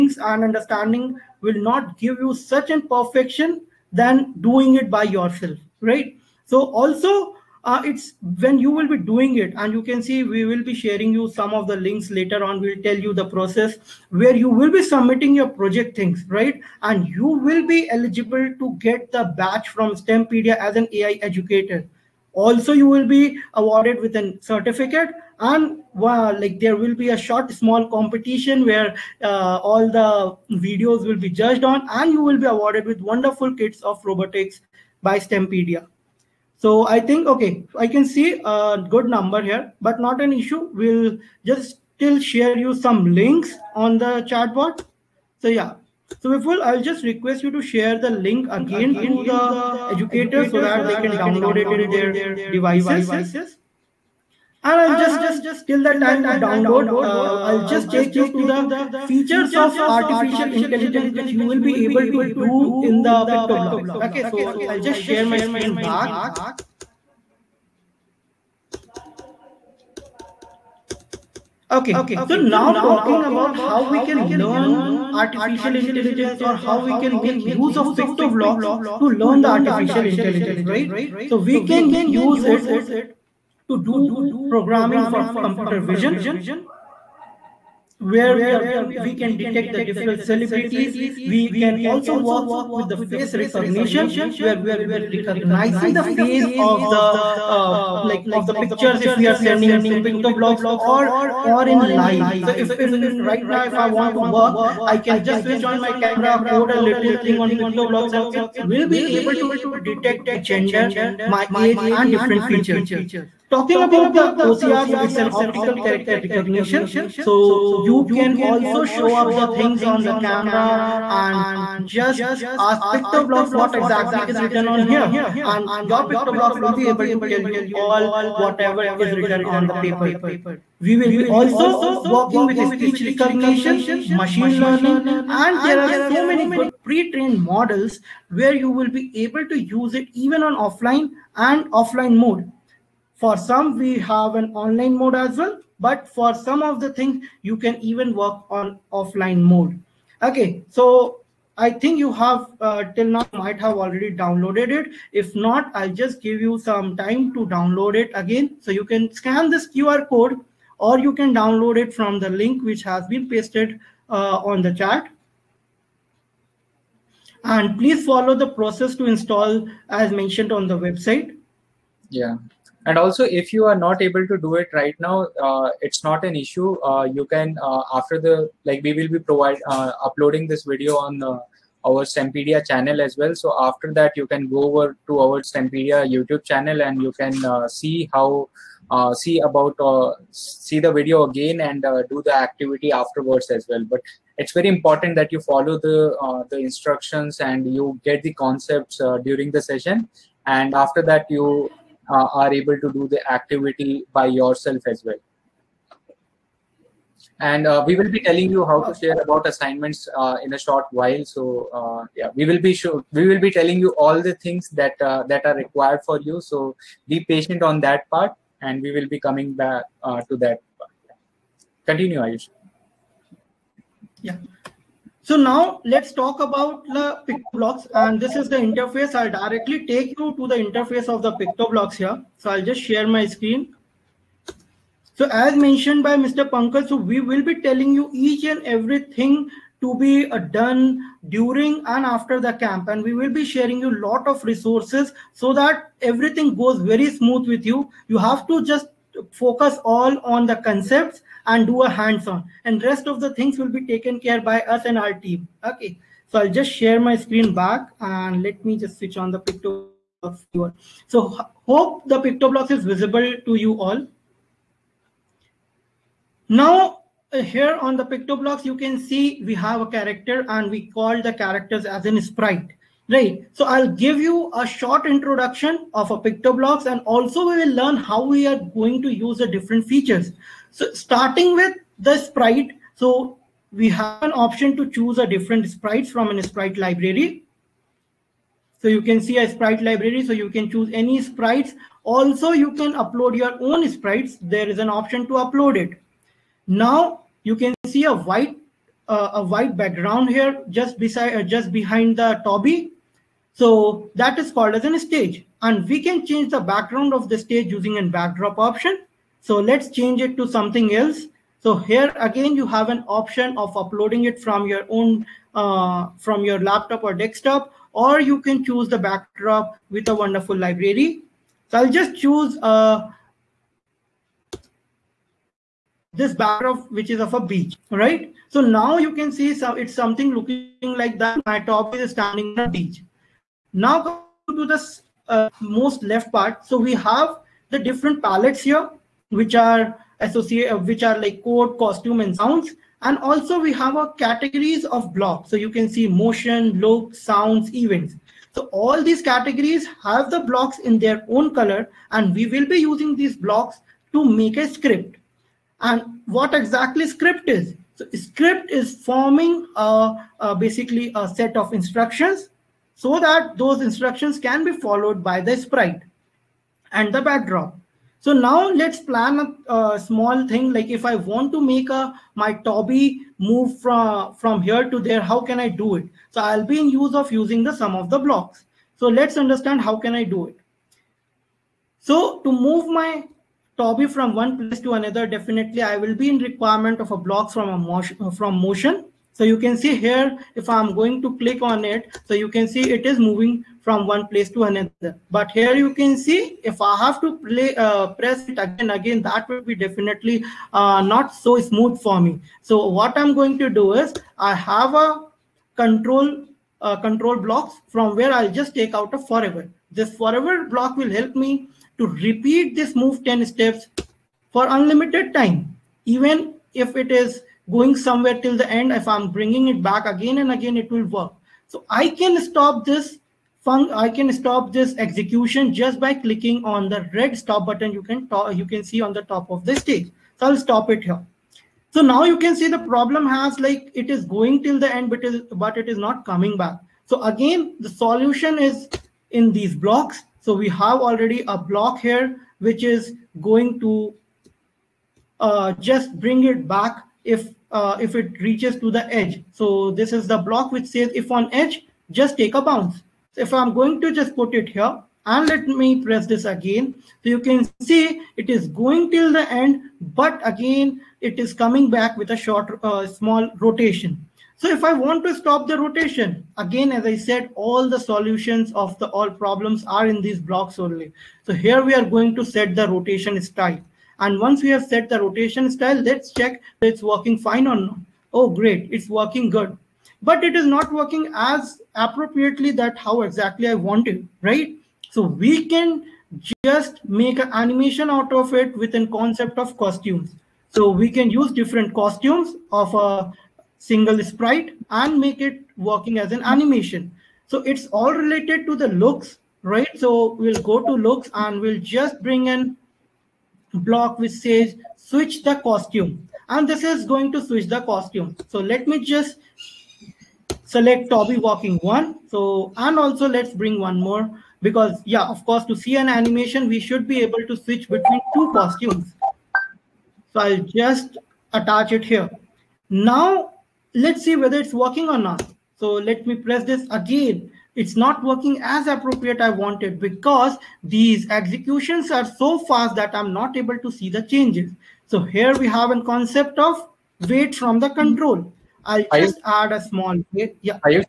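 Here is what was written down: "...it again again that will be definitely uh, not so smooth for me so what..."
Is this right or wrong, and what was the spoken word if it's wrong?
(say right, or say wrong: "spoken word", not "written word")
right.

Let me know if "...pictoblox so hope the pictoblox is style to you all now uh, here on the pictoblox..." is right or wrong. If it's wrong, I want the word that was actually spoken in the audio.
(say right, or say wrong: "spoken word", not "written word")
wrong: "visible", not "style".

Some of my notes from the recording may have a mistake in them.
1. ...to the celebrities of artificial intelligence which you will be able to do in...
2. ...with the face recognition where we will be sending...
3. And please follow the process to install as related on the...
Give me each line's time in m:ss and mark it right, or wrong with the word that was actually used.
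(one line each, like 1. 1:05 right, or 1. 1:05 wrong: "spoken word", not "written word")
1. 0:58 wrong: "features", not "celebrities"
2. 1:32 wrong: "recognizing", not "sending"
3. 2:47 wrong: "mentioned", not "related".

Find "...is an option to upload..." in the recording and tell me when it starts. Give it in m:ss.
4:54.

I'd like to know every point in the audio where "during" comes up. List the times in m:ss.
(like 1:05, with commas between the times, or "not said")
3:19, 4:01.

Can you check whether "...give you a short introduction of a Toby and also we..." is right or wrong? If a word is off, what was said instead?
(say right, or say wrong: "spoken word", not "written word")
wrong: "PictoBlox", not "Toby".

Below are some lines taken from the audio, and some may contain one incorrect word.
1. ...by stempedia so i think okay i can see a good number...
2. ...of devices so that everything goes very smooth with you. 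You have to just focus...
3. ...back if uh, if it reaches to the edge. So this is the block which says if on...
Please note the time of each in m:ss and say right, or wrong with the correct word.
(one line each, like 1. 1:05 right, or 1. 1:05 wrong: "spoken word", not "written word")
1. 0:35 right
2. 4:04 wrong: "resources", not "devices"
3. 7:26 right.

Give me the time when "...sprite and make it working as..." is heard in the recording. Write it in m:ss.
8:14.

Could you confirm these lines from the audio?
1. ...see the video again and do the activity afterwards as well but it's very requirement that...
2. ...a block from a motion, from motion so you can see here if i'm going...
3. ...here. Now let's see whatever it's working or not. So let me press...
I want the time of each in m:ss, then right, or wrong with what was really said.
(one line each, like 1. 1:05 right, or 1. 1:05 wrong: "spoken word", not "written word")
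1. 3:10 wrong: "important", not "requirement"
2. 6:27 right
3. 8:42 wrong: "whether", not "whatever".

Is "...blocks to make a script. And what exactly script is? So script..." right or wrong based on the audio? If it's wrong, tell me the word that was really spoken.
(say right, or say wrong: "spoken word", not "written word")
right.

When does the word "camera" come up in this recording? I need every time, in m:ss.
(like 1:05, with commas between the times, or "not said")
1:46, 2:00.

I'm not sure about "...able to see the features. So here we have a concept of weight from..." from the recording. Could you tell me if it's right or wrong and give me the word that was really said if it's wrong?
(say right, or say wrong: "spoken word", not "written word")
wrong: "changes", not "features".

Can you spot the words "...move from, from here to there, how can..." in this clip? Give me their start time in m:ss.
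6:13.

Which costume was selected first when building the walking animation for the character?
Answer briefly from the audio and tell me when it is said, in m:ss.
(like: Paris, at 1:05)
Toby walking one, at 8:31.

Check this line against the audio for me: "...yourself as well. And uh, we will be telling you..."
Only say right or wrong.
right.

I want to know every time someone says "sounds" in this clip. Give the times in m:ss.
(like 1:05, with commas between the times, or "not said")
5:42, 5:47.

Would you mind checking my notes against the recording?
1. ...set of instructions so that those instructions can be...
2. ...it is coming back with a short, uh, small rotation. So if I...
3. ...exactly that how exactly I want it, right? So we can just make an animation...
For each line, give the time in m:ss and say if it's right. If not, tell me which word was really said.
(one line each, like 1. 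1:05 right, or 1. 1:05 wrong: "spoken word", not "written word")
1. 6:01 right
2. 7:41 right
3. 8:01 wrong: "appropriately", not "exactly".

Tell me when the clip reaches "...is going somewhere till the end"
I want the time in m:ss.
6:57.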